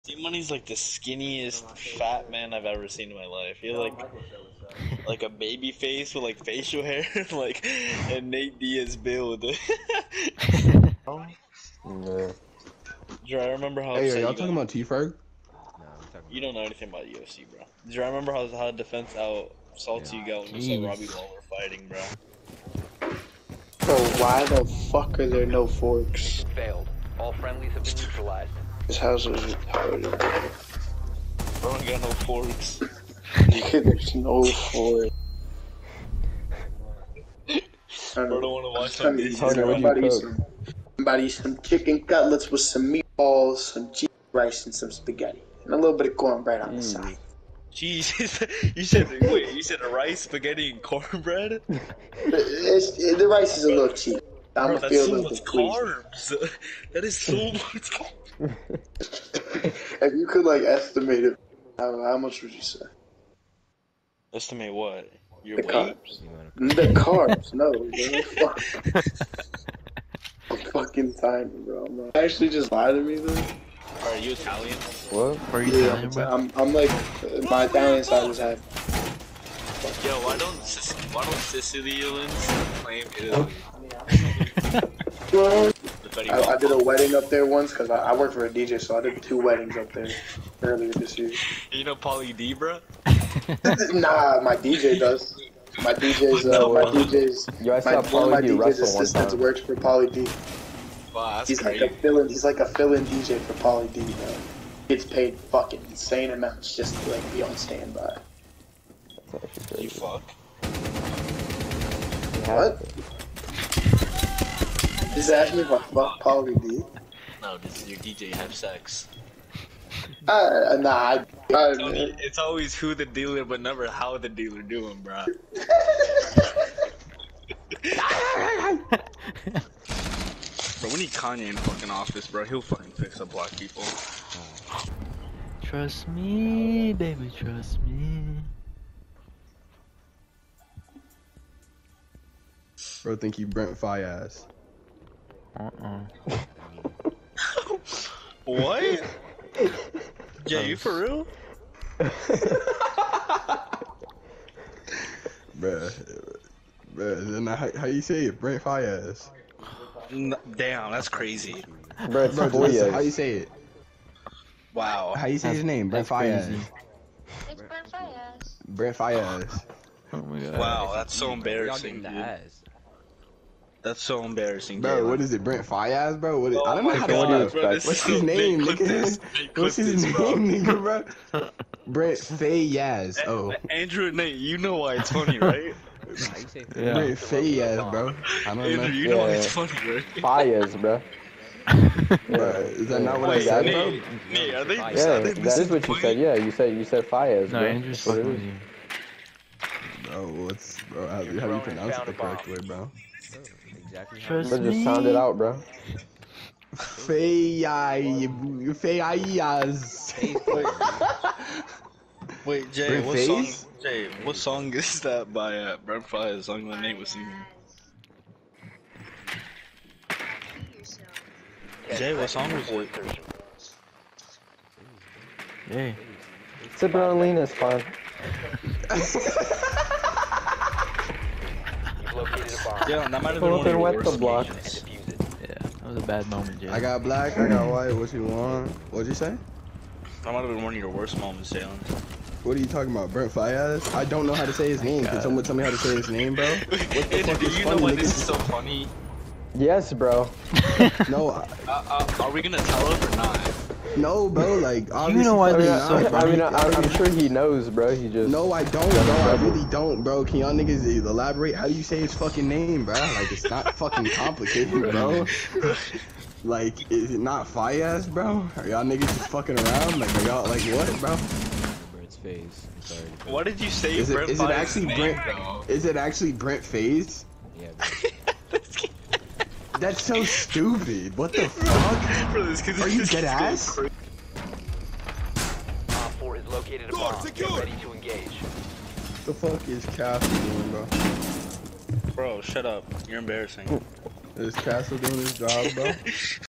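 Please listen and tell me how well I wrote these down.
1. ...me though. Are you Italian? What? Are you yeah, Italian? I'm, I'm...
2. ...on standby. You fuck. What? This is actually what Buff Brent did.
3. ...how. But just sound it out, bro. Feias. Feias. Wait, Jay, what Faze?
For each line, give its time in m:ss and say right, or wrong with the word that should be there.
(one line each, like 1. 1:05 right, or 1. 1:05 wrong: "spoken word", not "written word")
1. 1:13 right
2. 1:47 wrong: "Polly", not "Brent"
3. 3:24 right.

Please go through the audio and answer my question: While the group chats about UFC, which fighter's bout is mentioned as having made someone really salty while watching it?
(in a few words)
Robbie Lawler.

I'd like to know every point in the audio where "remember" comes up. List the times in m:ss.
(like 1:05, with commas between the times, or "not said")
0:13, 0:18.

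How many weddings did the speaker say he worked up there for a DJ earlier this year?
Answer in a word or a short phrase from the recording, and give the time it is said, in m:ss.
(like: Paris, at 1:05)
2, at 1:29.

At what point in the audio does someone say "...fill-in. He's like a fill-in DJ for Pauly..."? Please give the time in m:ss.
1:41.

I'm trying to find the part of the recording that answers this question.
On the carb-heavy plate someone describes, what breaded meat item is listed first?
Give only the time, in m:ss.
0:41.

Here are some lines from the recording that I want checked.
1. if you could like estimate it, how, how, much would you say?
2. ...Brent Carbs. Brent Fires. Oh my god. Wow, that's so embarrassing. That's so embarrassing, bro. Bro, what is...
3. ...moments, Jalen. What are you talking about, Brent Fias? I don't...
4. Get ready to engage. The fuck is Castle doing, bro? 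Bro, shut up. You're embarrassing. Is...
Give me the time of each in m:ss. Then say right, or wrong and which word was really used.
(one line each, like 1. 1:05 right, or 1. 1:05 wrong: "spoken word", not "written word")
1. 1:00 right
2. 2:47 wrong: "Fires", not "Carbs"
3. 4:01 right
4. 4:47 right.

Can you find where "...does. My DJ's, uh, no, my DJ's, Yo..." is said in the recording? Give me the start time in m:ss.
1:34.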